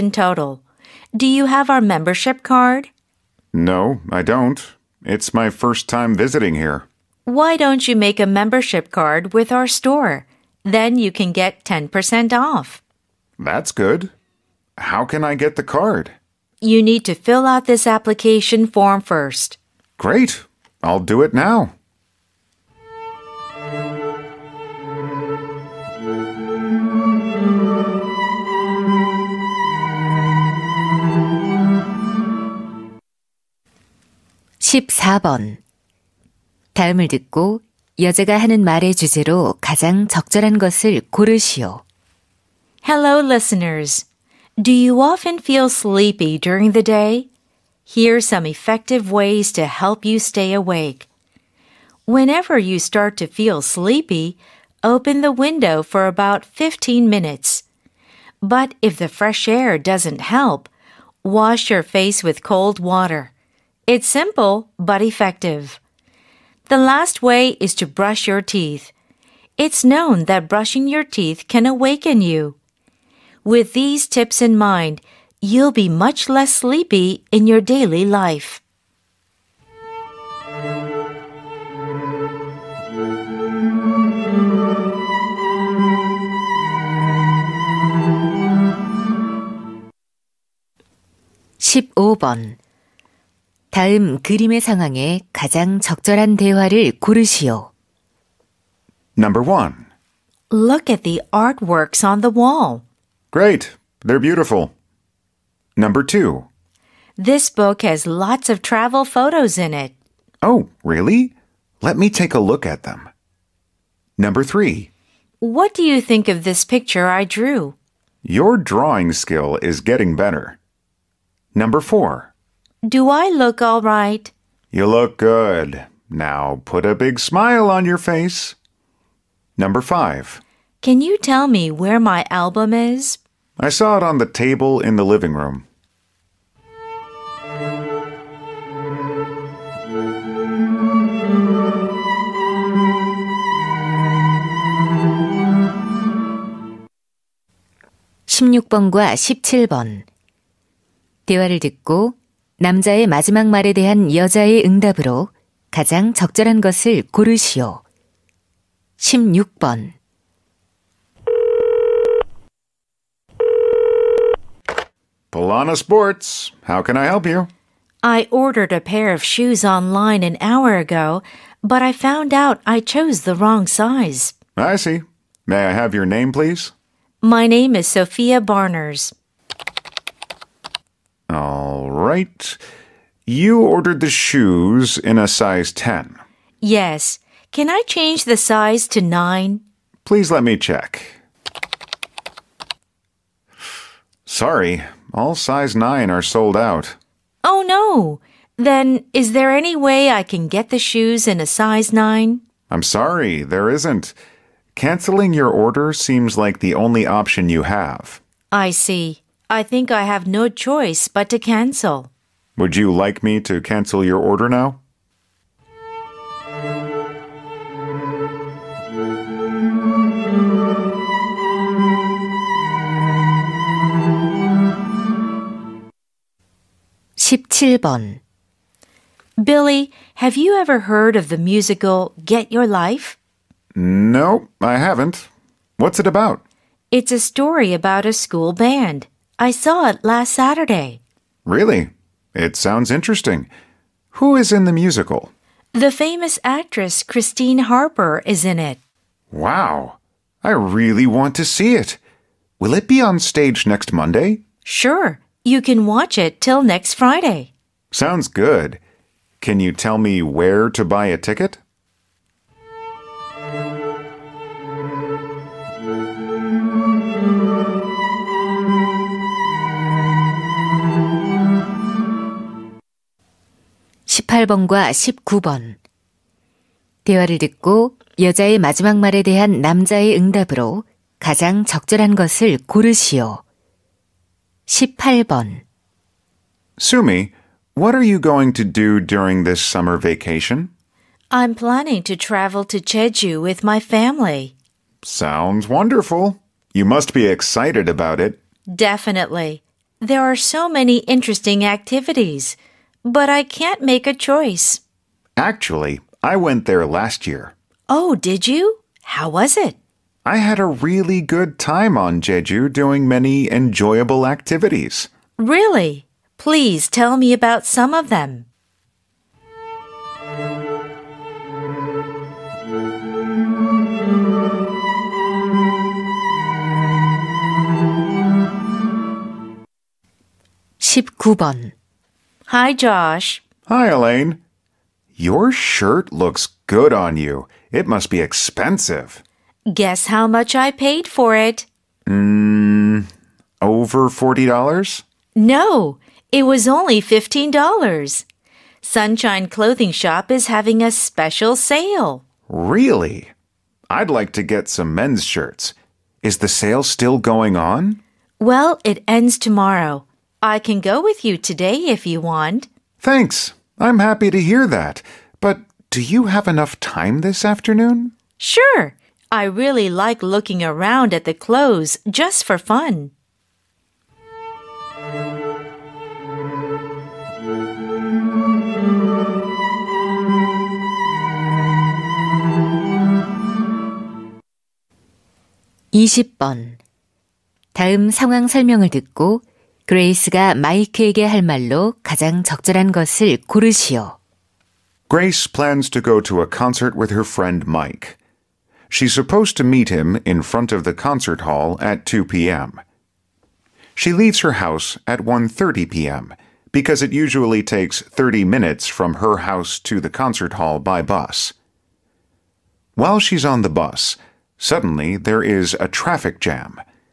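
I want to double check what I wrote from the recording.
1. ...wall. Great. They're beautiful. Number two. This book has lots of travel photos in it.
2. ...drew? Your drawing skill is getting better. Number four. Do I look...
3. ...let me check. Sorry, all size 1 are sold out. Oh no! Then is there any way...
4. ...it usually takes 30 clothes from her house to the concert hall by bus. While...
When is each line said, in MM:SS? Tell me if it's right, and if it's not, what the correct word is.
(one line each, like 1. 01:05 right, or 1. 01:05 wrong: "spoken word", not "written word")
1. 01:42 right
2. 01:57 right
3. 03:10 wrong: "9", not "1"
4. 06:47 wrong: "minutes", not "clothes".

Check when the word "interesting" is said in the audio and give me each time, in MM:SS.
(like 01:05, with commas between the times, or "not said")
04:02, 05:01.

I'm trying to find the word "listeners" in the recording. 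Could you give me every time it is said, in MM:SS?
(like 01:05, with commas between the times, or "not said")
00:43.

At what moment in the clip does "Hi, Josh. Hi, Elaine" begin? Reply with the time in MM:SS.
05:32.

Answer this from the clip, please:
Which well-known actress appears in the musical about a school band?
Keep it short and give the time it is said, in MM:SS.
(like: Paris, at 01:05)
Christine Harper, at 04:07.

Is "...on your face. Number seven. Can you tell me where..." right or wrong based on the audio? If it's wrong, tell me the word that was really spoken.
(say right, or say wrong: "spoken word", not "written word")
wrong: "five", not "seven".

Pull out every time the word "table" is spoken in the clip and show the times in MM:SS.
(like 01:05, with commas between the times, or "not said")
02:14.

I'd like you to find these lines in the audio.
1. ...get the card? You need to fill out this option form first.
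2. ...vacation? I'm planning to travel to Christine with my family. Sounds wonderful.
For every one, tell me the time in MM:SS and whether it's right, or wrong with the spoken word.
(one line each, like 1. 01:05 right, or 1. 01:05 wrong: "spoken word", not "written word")
1. 00:15 wrong: "application", not "option"
2. 04:49 wrong: "Jeju", not "Christine".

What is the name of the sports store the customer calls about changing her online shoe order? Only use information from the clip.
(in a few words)
Polana Sports.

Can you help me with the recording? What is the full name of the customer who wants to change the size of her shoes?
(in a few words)
Sophia Barners.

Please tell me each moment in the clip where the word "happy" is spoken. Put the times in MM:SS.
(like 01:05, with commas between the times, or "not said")
06:03.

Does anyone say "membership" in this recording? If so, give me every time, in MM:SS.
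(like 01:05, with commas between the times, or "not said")
00:01, 00:08.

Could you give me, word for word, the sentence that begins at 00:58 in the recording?
But if the fresh air doesn't help, wash your face with cold water.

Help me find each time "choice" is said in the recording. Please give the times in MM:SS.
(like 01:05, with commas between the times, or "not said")
03:30, 05:04.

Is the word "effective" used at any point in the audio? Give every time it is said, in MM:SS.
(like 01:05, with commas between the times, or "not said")
00:48, 01:05.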